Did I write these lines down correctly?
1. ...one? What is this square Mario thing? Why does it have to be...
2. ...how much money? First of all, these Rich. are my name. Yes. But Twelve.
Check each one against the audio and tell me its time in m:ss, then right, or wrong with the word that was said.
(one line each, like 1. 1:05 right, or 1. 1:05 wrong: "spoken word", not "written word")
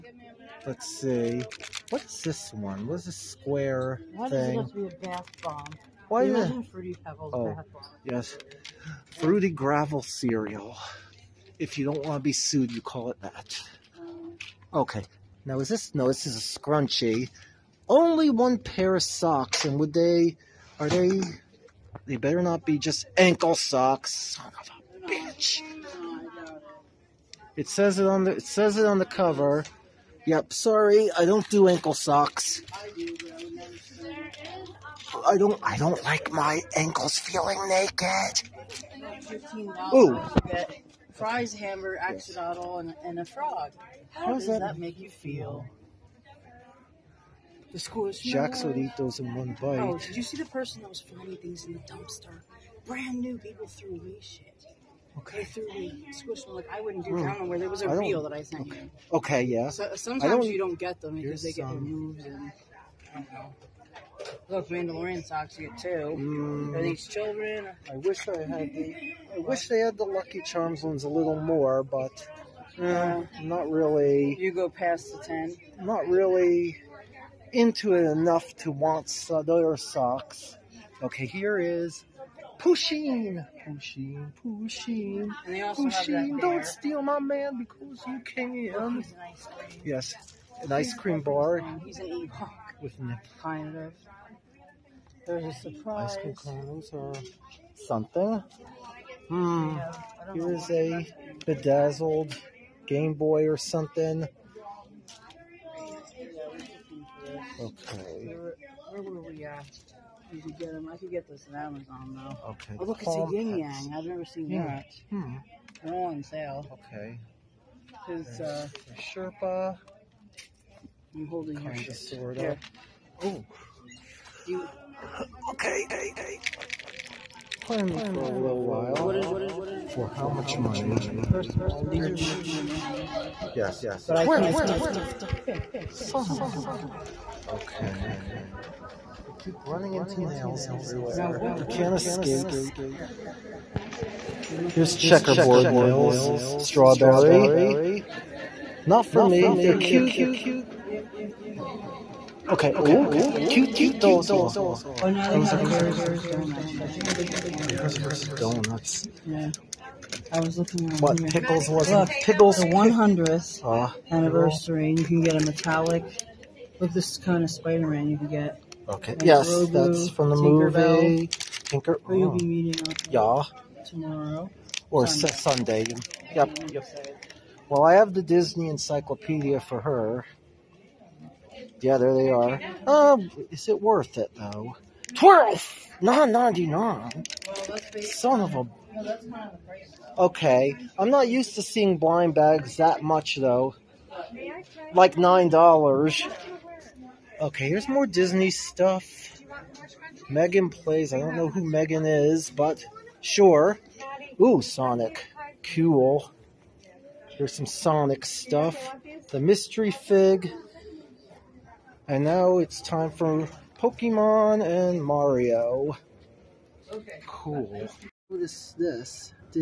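1. 0:02 wrong: "Why", not "Mario"
2. 2:10 right.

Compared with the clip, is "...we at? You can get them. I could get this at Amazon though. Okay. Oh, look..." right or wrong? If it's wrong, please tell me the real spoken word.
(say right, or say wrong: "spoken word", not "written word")
right.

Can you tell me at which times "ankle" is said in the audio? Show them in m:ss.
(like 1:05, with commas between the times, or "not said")
0:23, 0:31, 0:36.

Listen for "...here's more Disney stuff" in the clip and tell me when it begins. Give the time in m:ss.
3:17.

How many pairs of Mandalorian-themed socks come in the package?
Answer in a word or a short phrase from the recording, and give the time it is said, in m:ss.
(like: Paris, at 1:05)
2, at 1:05.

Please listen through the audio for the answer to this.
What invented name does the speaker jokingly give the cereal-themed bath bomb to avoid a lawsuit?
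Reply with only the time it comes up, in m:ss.
0:09.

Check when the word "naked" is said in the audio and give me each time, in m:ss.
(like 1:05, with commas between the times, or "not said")
0:37.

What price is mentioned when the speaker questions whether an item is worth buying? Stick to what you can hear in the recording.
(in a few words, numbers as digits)
$12.99.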